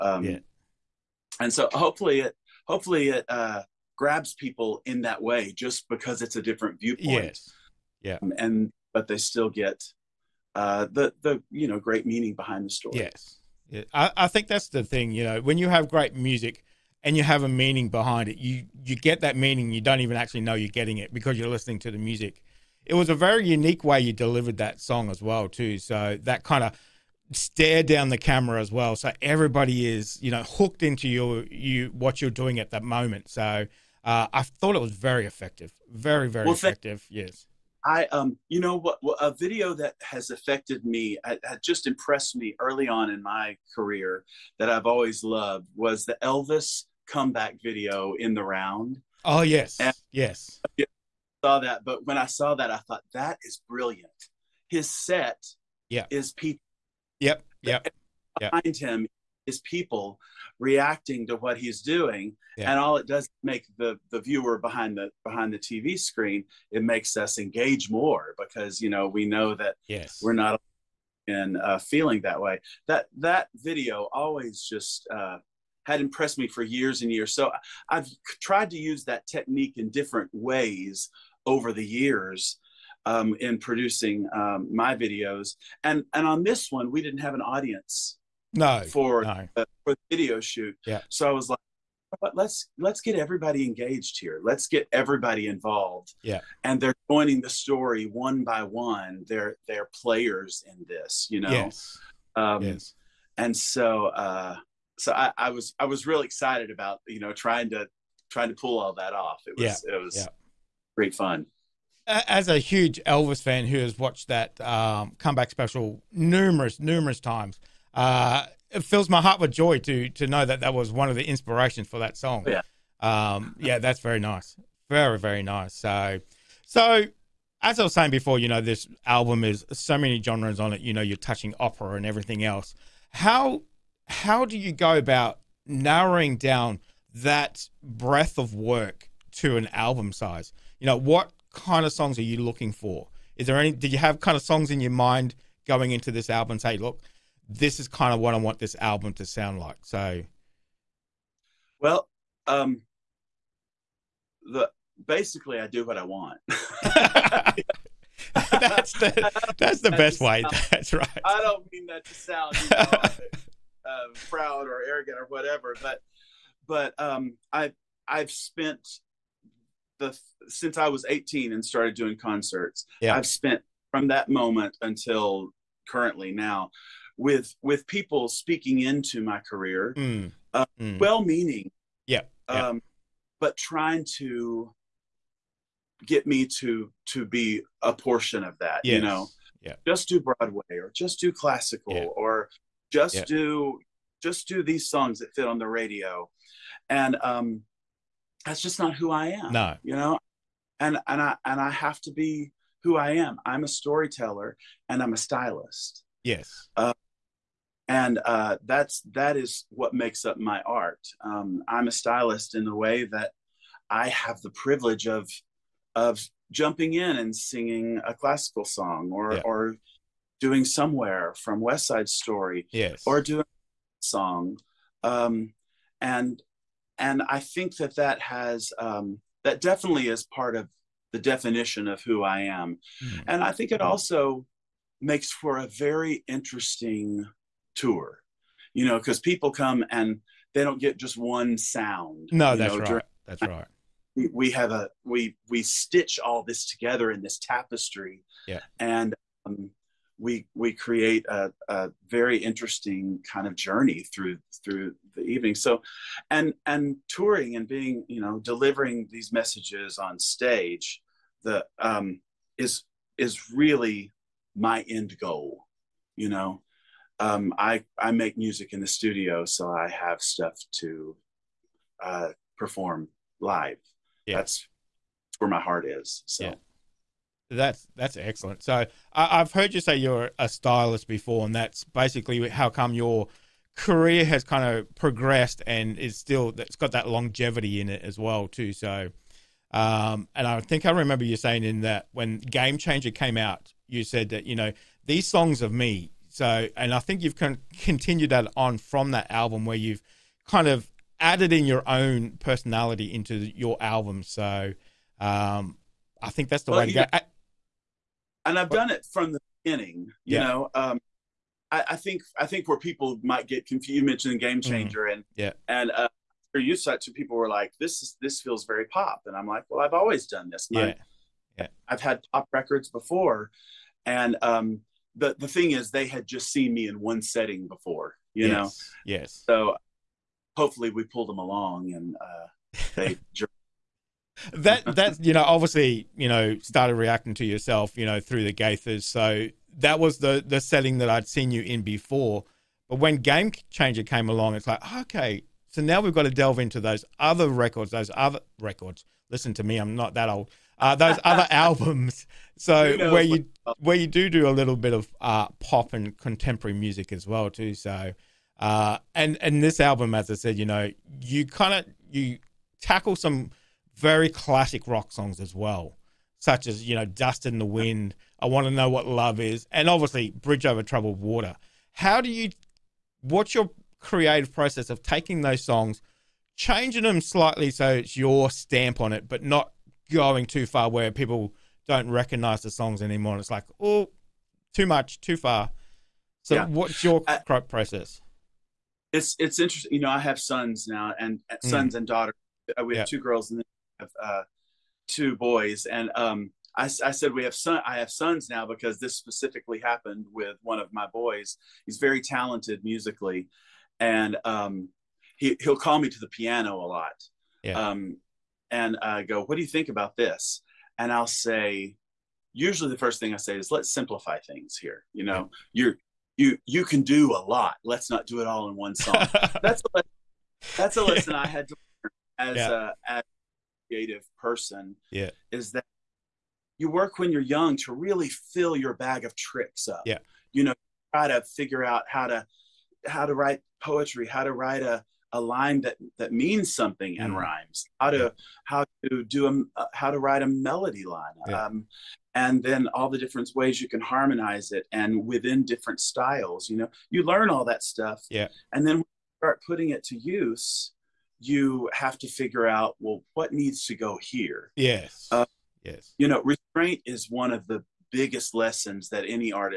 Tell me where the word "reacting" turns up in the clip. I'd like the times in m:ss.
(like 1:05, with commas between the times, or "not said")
1:00, 5:36.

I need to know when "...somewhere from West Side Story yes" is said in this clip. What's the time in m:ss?
3:40.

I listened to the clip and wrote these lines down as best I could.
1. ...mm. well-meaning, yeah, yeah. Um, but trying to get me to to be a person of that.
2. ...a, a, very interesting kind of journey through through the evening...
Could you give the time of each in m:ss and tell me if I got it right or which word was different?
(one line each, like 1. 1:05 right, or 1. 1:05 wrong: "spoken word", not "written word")
1. 3:00 wrong: "portion", not "person"
2. 4:11 right.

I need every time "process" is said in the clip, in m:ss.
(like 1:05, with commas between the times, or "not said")
6:14, 6:27.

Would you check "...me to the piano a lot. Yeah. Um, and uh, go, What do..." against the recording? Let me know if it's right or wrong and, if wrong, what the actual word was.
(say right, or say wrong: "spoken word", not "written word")
right.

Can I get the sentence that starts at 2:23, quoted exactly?
Did you have kind of songs in your mind going into this album?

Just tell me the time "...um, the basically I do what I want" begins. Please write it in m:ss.
2:32.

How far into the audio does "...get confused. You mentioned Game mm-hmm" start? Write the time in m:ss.
5:13.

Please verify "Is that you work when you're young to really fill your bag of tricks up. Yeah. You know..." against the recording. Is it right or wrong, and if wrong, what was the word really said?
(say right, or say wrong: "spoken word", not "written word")
right.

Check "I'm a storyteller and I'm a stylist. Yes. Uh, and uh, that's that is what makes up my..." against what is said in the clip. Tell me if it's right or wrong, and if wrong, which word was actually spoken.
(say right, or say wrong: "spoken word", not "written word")
right.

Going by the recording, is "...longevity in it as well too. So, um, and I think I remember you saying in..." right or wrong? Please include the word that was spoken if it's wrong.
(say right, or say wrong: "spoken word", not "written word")
right.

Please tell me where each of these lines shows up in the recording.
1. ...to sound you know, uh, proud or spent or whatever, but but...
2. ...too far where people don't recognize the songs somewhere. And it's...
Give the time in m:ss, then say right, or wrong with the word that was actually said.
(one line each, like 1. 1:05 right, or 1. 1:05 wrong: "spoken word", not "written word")
1. 2:42 wrong: "arrogant", not "spent"
2. 6:20 wrong: "anymore", not "somewhere".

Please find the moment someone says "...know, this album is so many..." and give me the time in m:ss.
2:08.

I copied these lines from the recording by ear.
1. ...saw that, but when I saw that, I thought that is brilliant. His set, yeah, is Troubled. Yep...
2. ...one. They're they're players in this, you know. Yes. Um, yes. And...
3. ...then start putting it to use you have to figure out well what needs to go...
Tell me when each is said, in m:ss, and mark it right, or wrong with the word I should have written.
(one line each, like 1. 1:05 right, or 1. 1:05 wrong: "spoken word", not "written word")
1. 0:51 wrong: "Pete", not "Troubled"
2. 1:38 right
3. 7:28 right.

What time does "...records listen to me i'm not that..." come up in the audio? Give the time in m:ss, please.
5:48.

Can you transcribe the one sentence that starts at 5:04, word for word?
So, um, I think that's the well, way to go.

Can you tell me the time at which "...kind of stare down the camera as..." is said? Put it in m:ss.
0:26.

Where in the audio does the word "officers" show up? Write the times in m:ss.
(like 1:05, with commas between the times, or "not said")
not said.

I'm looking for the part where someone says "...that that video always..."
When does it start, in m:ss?
1:12.